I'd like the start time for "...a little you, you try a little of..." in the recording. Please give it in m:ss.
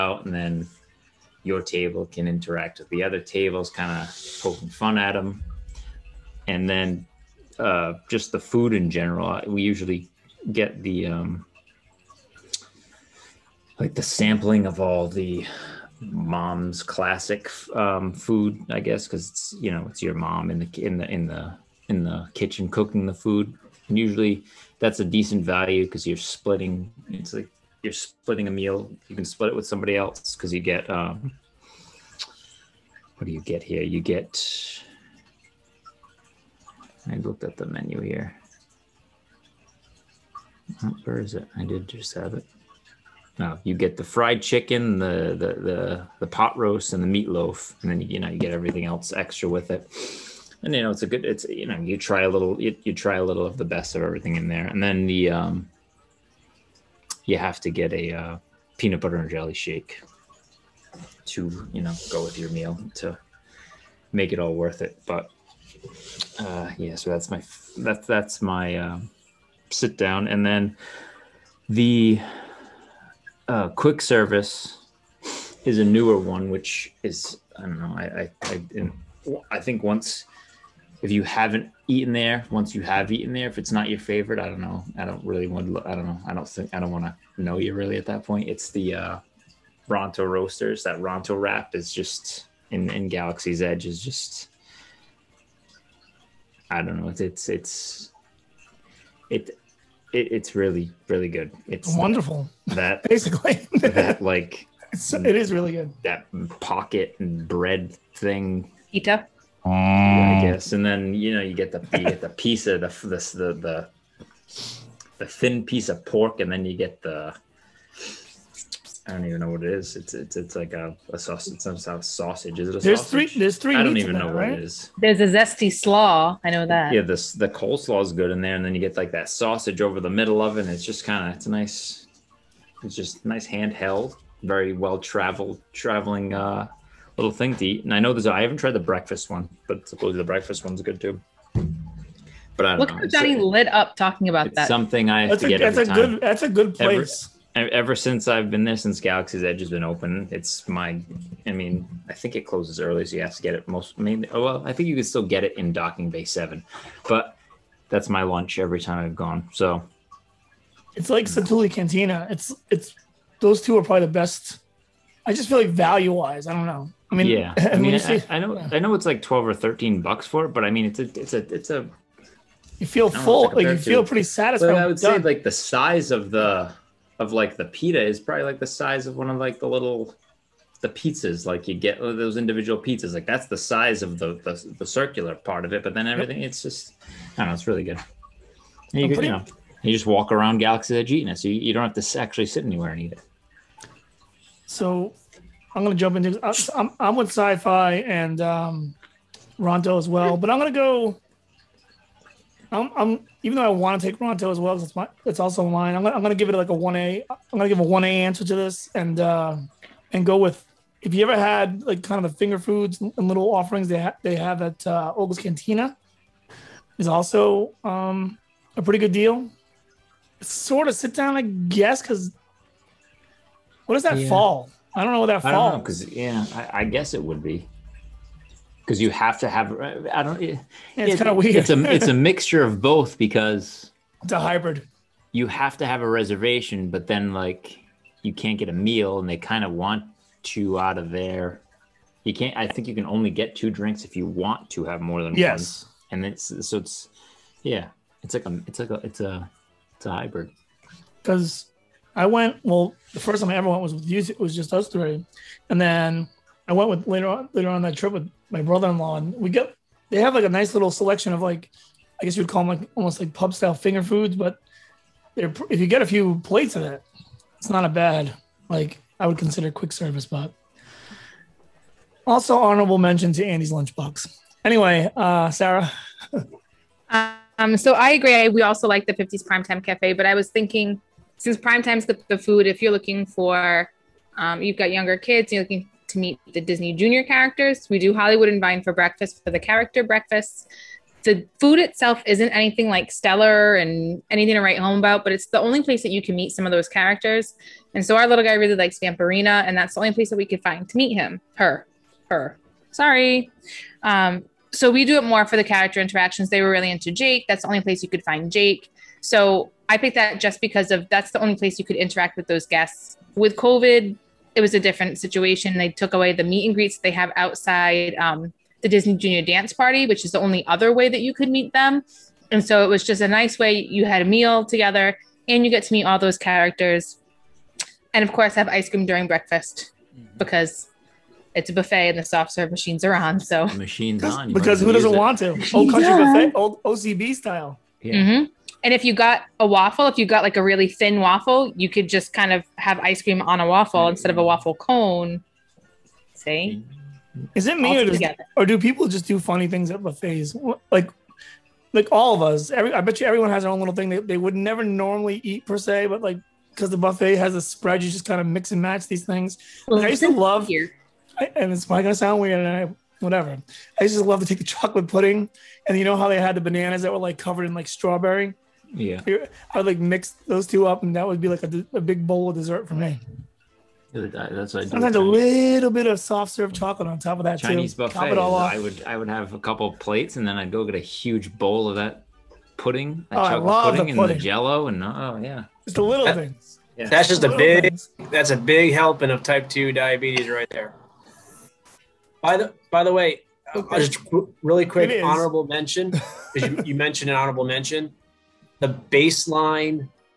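0:52.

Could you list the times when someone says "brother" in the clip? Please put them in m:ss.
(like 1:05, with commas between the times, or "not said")
4:18.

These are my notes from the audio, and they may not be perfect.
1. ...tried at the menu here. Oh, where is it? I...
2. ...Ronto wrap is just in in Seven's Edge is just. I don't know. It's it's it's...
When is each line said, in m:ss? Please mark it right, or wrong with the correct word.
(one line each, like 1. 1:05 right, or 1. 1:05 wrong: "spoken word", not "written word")
1. 0:37 wrong: "looked", not "tried"
2. 1:30 wrong: "Galaxy", not "Seven".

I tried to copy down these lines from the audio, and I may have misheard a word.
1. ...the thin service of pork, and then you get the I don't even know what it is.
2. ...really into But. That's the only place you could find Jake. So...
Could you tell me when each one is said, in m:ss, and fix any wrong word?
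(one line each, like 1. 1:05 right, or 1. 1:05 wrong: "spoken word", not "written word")
1. 1:55 wrong: "piece", not "service"
2. 5:06 wrong: "Jake", not "But".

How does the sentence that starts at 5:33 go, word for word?
So the machines on because who doesn't it.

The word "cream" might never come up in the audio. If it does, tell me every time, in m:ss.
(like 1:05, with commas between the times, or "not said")
5:28, 5:43.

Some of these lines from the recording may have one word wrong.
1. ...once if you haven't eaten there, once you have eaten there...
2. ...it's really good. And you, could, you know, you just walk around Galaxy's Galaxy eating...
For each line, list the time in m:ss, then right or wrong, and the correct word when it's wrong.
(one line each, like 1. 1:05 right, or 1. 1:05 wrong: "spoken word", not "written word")
1. 1:19 right
2. 3:07 wrong: "Edge", not "Galaxy".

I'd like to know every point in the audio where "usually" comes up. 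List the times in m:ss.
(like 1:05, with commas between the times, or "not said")
0:09, 0:23.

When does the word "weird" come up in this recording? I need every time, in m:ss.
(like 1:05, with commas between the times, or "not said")
3:51, 6:02.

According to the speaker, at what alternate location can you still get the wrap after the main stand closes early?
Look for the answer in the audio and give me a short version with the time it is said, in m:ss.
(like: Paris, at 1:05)
Docking Bay Seven, at 2:35.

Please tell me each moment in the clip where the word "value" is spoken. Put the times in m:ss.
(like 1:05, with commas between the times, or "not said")
0:25, 2:45.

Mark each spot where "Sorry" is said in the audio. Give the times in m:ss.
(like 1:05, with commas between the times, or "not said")
5:02.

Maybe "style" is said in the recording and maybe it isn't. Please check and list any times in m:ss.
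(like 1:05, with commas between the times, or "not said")
4:23, 5:37.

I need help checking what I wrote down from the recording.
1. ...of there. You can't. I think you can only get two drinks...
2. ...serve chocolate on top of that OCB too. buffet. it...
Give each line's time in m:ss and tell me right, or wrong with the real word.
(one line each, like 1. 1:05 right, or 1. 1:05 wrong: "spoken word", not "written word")
1. 4:00 right
2. 6:16 wrong: "Chinese", not "OCB".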